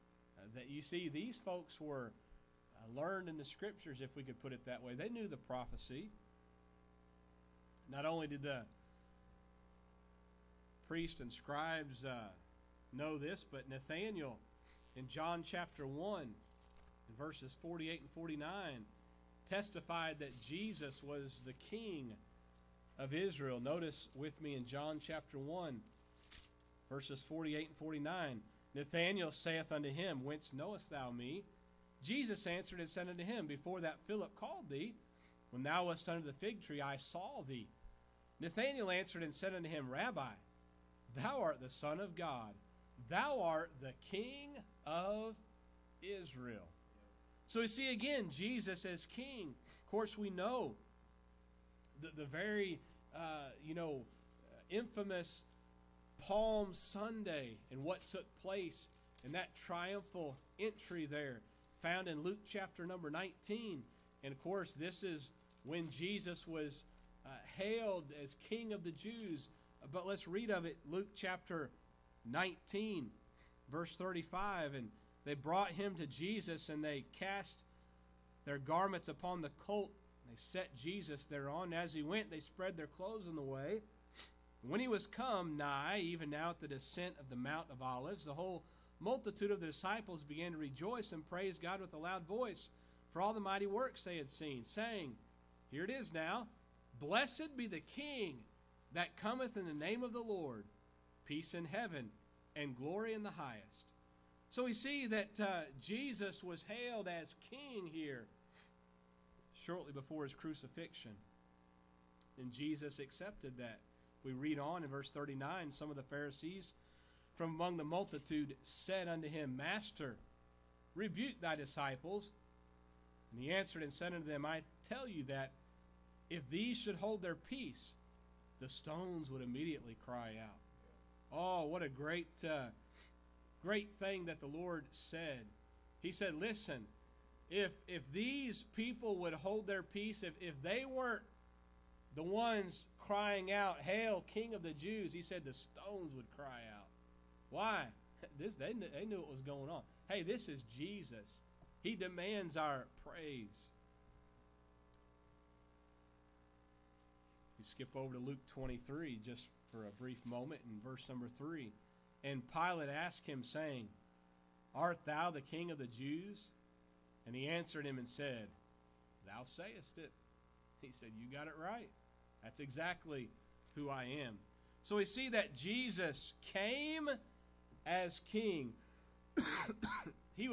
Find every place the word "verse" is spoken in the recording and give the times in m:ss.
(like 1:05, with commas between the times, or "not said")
0:17, 0:26, 1:13, 1:54, 2:40.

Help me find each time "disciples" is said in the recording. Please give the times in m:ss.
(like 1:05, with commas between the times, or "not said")
1:29, 2:01.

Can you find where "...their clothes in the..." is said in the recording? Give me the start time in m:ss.
1:22.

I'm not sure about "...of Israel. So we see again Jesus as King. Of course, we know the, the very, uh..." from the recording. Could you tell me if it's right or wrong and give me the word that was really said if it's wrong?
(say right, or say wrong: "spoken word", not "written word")
right.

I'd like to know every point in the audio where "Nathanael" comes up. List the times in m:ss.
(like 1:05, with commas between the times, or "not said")
0:13, 0:28, 0:38.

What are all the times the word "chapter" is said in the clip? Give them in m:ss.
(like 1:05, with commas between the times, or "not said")
0:15, 0:25, 1:02, 1:11.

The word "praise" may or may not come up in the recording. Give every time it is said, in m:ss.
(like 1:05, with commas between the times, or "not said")
1:31, 2:33.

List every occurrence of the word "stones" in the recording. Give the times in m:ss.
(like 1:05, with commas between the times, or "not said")
2:08, 2:25.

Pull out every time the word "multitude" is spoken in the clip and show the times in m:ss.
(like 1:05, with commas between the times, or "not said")
1:28, 1:57.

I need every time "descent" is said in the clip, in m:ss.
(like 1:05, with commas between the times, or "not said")
1:26.